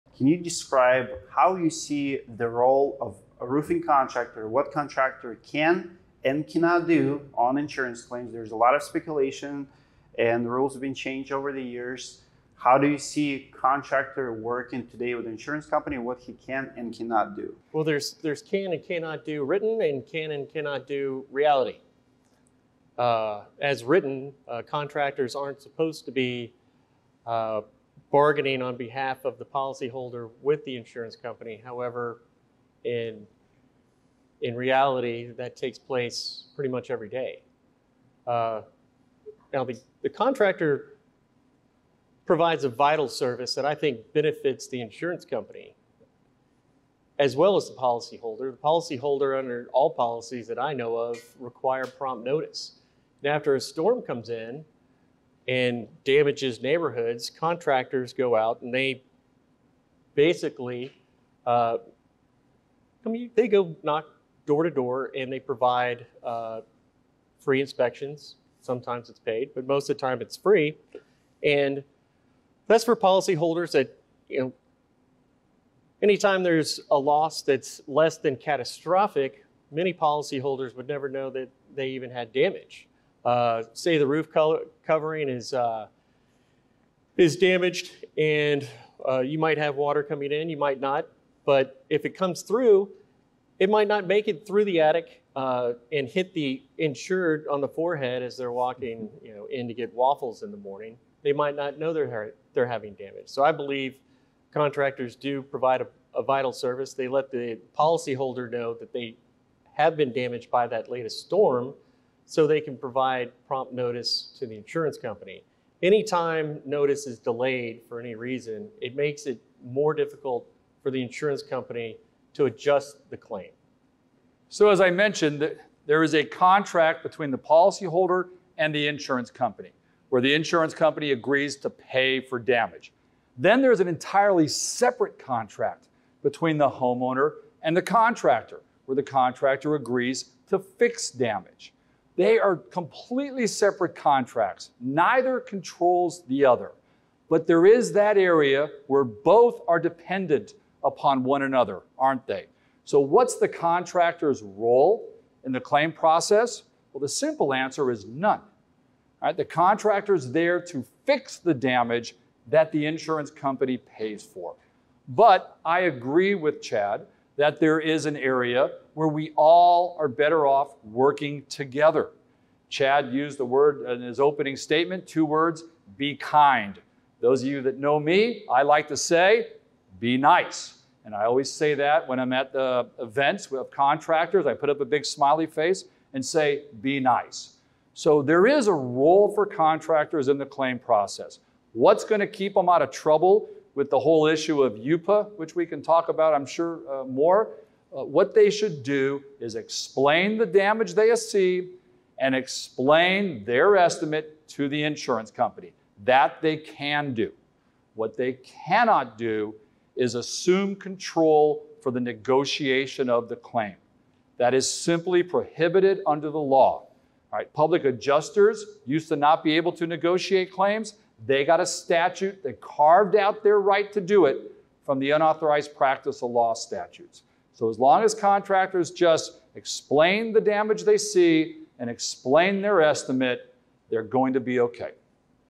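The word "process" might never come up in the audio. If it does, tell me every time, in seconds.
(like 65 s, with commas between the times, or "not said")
155 s, 190 s.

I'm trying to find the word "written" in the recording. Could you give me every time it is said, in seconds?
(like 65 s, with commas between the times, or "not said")
19 s, 23 s.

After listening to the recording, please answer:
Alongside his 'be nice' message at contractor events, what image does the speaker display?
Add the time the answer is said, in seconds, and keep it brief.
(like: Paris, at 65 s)
a big smiley face, at 184 s.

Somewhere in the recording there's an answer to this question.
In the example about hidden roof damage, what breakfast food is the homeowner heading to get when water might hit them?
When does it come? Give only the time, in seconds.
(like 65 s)
99 s.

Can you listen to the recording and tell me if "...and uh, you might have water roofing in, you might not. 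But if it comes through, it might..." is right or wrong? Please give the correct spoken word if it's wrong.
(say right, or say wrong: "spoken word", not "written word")
wrong: "coming", not "roofing".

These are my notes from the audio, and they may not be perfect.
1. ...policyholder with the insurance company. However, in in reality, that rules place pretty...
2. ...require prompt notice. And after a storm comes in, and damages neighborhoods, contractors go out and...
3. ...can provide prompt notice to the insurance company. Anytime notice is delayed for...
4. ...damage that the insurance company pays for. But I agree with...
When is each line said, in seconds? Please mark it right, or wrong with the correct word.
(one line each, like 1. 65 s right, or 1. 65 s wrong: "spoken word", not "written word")
1. 29 s wrong: "takes", not "rules"
2. 51 s right
3. 112 s right
4. 161 s right.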